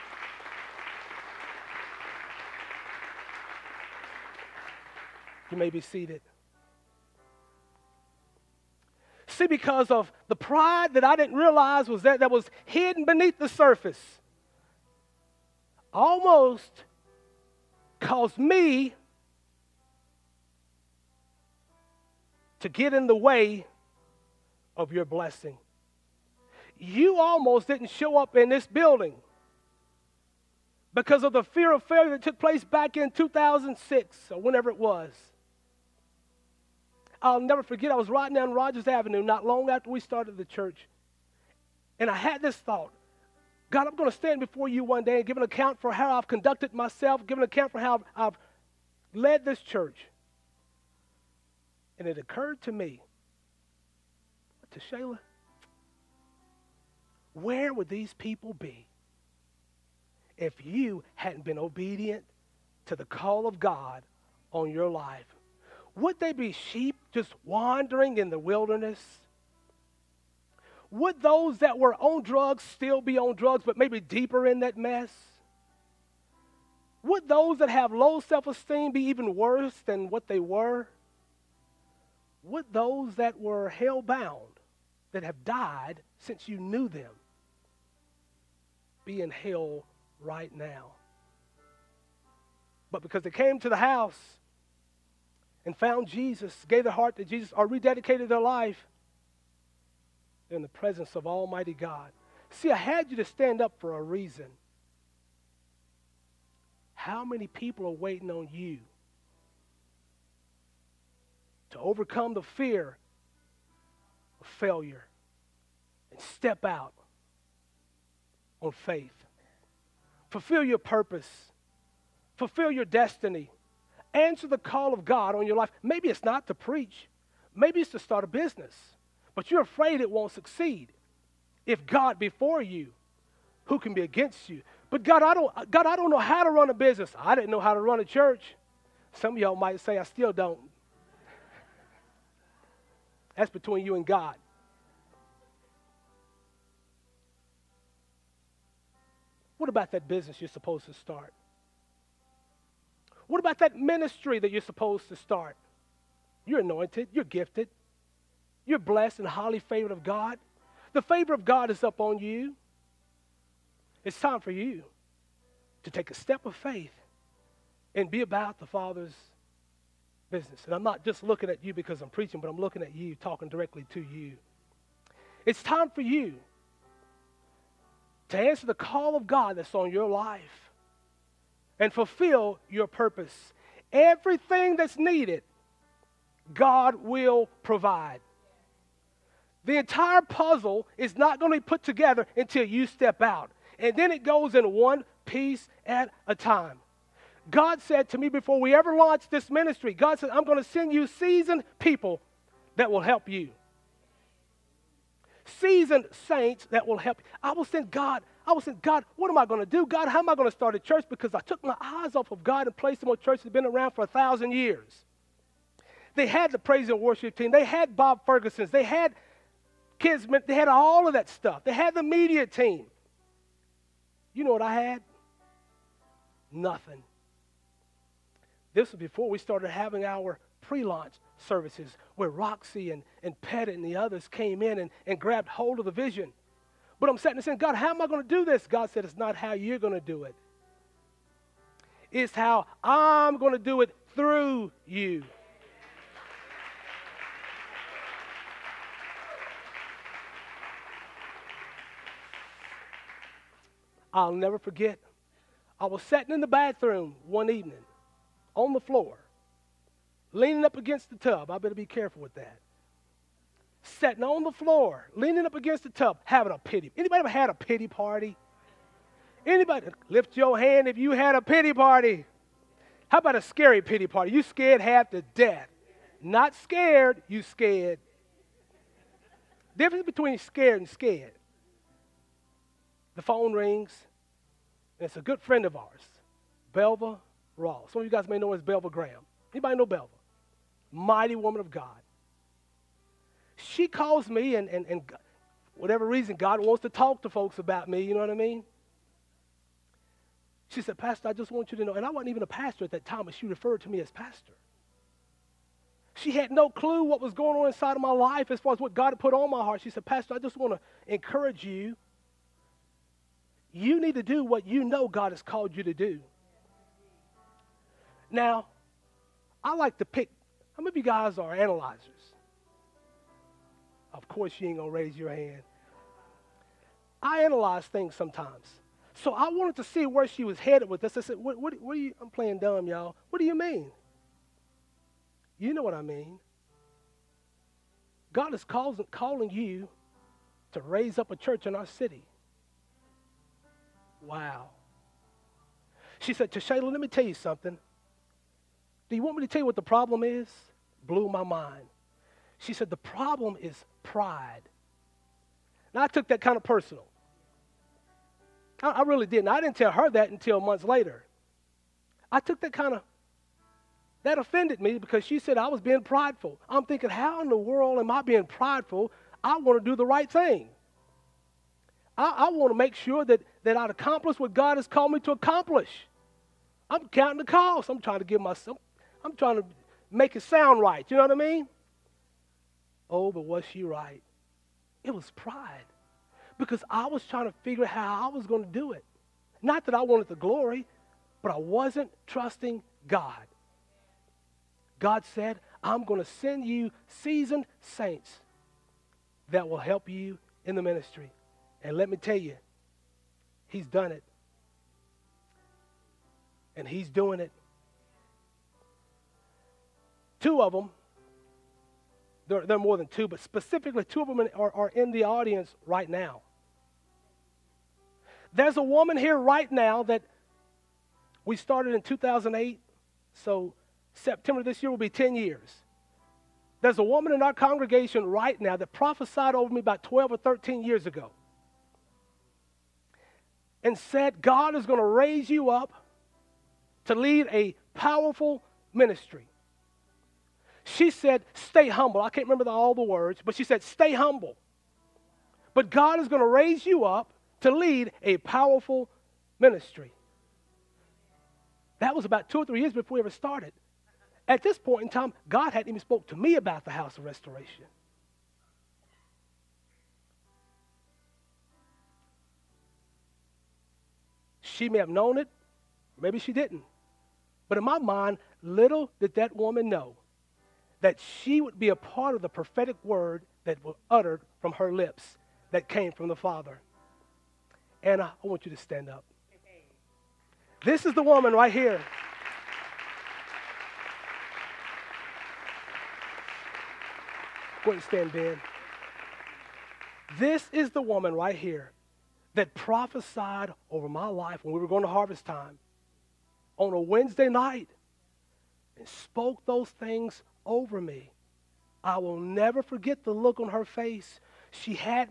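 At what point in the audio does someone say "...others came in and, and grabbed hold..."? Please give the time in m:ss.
3:53.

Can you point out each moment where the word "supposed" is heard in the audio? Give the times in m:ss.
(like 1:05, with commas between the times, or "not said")
2:30, 2:34.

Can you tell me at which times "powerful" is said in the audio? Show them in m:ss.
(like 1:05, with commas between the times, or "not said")
7:17, 7:28.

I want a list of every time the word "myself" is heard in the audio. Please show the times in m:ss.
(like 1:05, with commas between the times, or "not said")
0:46, 6:18.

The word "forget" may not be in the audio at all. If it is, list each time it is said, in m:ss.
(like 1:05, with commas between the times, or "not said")
0:37, 4:14, 8:22.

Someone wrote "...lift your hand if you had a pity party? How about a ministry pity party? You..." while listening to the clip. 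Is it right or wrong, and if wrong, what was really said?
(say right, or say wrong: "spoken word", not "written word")
wrong: "scary", not "ministry".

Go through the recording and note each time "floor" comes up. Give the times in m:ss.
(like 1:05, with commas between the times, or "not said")
4:18, 4:24.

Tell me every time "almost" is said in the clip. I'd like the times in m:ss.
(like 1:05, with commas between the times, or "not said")
0:15, 0:27.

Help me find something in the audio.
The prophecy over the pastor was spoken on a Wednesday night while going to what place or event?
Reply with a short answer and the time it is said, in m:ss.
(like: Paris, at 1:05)
Harvest time, at 8:15.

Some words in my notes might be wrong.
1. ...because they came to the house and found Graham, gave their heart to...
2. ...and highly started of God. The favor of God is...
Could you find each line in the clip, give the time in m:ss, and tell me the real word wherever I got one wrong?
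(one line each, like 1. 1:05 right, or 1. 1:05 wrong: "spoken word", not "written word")
1. 1:33 wrong: "Jesus", not "Graham"
2. 2:39 wrong: "favored", not "started".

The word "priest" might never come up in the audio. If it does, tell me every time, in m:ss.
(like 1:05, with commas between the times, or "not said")
not said.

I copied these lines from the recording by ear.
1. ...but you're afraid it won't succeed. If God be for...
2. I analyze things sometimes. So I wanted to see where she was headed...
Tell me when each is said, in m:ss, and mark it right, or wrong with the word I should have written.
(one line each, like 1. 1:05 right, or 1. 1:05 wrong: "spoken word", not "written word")
1. 2:09 right
2. 5:27 right.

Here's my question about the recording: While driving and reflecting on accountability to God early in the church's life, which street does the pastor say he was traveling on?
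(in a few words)
Rogers Avenue.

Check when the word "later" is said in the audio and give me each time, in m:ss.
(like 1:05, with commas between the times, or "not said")
6:00.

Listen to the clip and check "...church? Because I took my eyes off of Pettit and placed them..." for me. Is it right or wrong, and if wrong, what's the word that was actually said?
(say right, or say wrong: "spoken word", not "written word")
wrong: "God", not "Pettit".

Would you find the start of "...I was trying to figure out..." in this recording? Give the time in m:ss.
6:26.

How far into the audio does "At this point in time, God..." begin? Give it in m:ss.
7:34.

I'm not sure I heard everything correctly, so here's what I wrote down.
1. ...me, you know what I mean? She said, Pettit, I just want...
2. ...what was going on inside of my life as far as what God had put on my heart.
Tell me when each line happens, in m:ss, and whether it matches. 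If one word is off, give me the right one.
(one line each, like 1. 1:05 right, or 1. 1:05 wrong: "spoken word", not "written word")
1. 4:57 wrong: "Pastor", not "Pettit"
2. 5:07 right.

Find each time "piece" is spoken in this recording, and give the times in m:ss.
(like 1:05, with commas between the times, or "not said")
3:15.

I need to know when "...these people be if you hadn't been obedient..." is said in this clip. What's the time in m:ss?
0:57.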